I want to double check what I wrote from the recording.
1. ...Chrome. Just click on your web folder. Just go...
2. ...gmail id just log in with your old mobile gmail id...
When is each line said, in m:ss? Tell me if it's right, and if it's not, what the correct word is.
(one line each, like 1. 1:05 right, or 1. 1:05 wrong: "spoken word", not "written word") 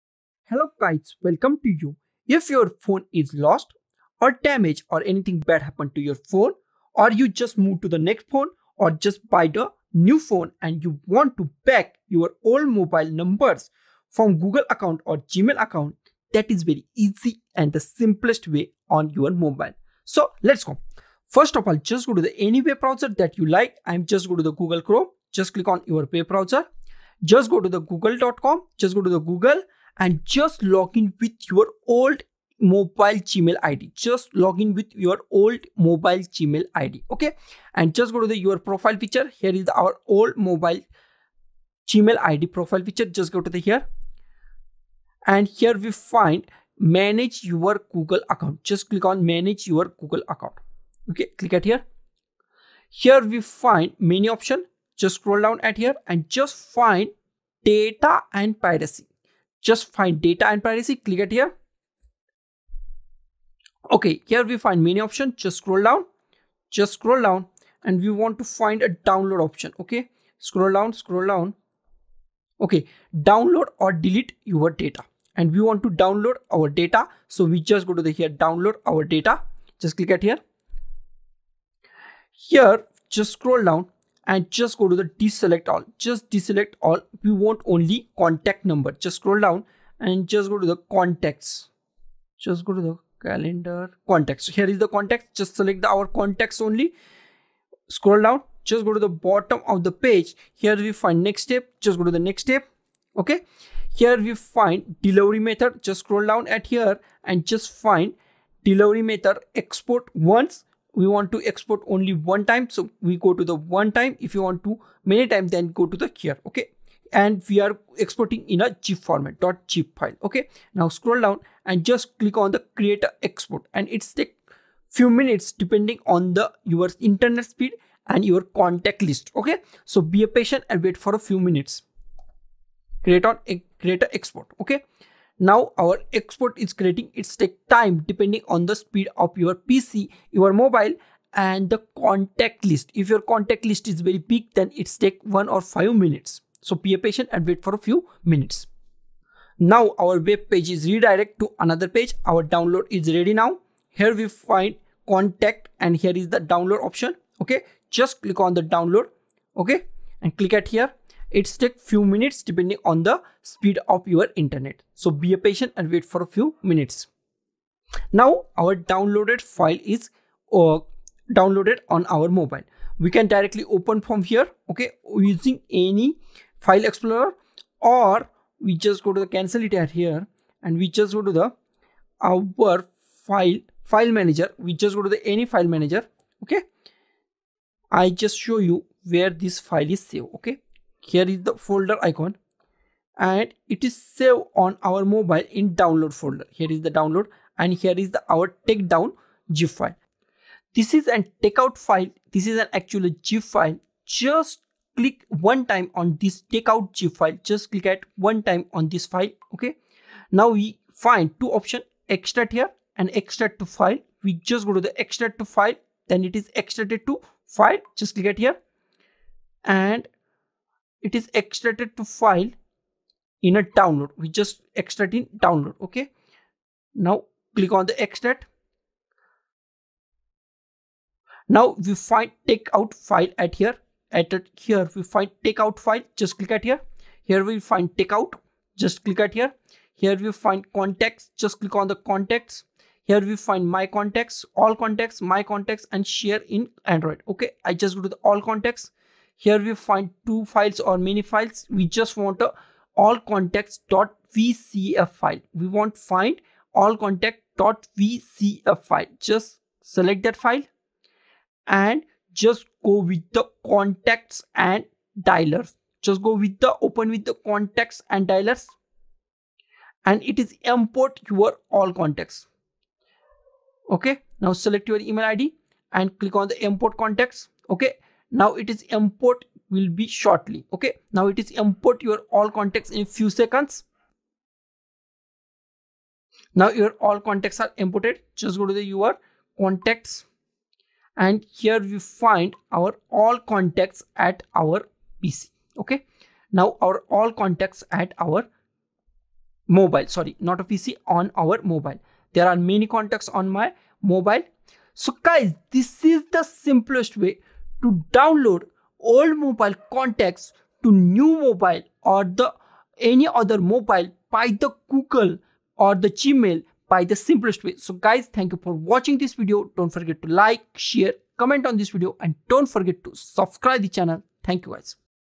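1. 0:24 wrong: "browser", not "folder"
2. 0:33 right.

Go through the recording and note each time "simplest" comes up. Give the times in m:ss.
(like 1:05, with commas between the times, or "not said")
0:17, 5:06, 5:17.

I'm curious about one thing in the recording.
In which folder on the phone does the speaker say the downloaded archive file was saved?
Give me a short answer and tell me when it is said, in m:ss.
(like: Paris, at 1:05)
Download folder, at 3:15.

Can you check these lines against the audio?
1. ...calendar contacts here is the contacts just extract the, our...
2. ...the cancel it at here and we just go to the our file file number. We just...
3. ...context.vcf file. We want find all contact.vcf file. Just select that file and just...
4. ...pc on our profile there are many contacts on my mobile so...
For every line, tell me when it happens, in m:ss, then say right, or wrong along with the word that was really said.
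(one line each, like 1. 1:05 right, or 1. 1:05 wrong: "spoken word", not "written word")
1. 1:33 wrong: "select", not "extract"
2. 2:59 wrong: "manager", not "number"
3. 4:13 right
4. 5:00 wrong: "mobile", not "profile".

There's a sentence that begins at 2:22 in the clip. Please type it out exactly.
If your contact list is very big, then it's take one or five minutes.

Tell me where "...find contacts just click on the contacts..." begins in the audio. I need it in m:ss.
4:00.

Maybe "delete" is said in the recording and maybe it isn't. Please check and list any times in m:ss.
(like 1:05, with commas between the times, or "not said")
1:13.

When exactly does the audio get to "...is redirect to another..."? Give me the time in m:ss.
2:30.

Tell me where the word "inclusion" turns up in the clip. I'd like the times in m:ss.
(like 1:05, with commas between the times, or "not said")
not said.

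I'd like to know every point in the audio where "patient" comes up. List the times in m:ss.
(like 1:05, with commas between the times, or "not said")
2:10, 2:27, 2:45.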